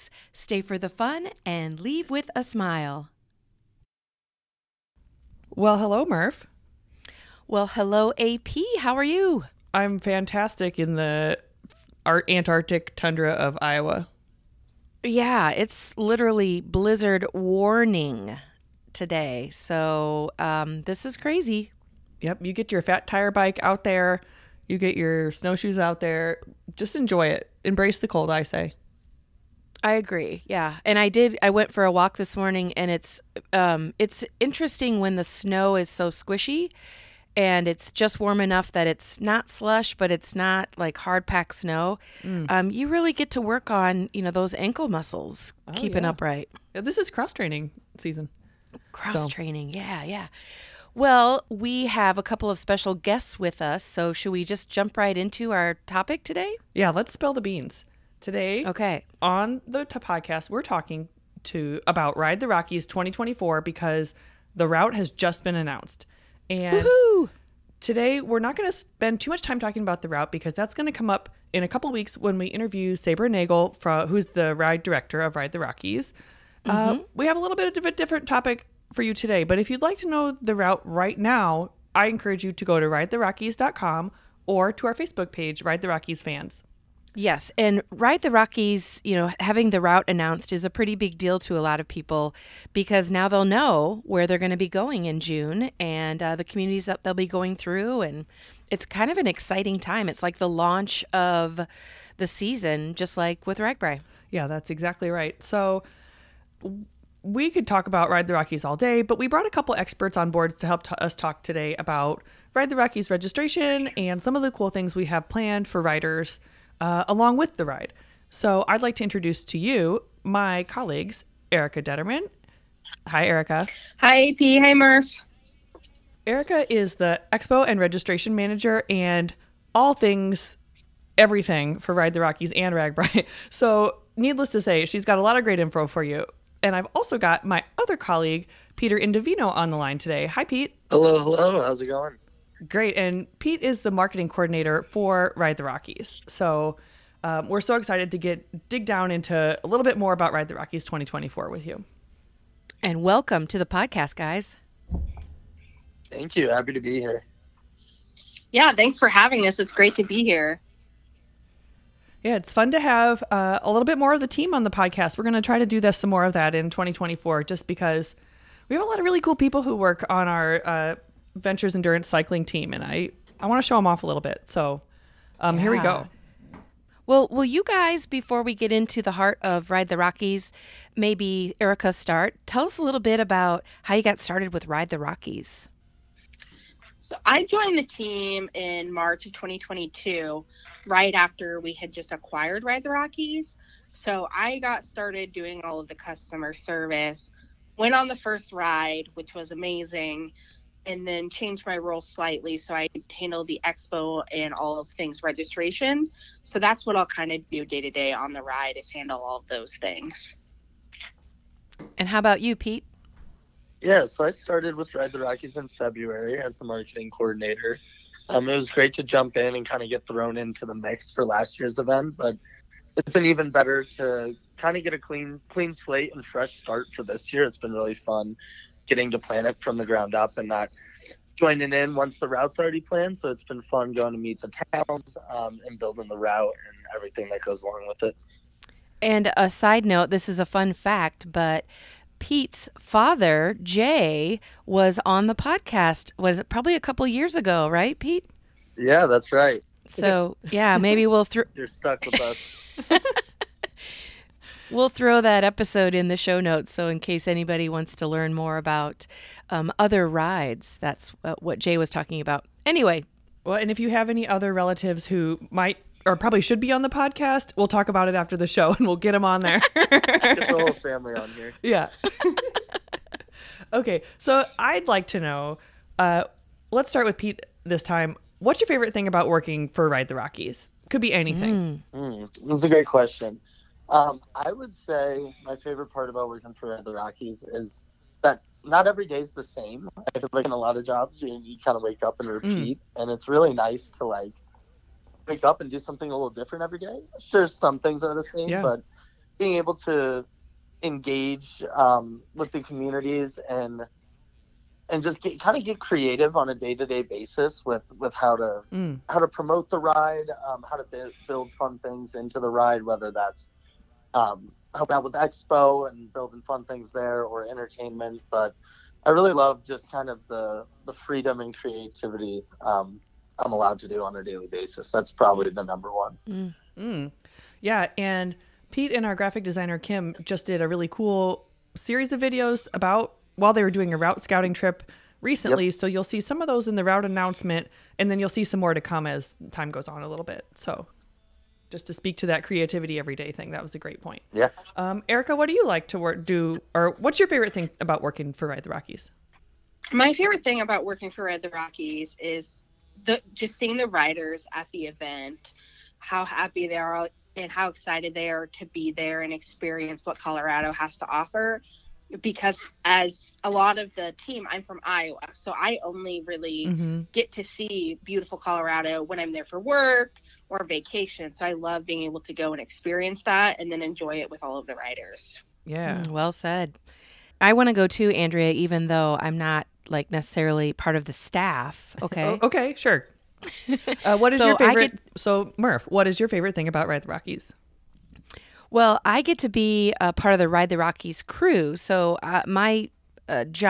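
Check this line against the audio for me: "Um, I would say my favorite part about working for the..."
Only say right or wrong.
right.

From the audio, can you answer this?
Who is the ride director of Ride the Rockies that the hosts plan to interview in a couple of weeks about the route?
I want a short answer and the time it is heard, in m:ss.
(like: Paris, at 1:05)
Saber Nagel, at 1:12.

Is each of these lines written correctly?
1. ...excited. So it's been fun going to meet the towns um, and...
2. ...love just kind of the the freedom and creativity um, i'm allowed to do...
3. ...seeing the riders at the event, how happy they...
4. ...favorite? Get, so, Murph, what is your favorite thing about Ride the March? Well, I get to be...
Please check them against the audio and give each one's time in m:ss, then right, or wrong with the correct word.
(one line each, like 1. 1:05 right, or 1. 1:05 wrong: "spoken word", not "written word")
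1. 3:52 wrong: "planned", not "excited"
2. 5:19 right
3. 5:53 right
4. 6:24 wrong: "Rockies", not "March".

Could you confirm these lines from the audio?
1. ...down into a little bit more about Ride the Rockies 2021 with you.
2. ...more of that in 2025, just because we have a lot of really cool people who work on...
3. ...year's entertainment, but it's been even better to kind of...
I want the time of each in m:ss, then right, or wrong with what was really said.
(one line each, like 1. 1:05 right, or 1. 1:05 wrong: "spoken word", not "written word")
1. 2:28 wrong: "2024", not "2021"
2. 2:46 wrong: "2024", not "2025"
3. 3:41 wrong: "event", not "entertainment".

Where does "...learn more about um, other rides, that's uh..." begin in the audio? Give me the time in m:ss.
4:18.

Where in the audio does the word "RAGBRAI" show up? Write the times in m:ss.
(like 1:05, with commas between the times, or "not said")
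1:43, 2:12.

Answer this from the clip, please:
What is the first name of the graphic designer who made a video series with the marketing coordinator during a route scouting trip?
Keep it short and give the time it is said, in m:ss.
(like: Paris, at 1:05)
Kim, at 5:29.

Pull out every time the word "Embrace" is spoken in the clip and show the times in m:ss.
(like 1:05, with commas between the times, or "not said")
0:27.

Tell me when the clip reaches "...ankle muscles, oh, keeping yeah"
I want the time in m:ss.
0:44.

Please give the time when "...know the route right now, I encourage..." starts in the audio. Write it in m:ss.
1:20.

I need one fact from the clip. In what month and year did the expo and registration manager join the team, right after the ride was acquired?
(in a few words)
March 2022.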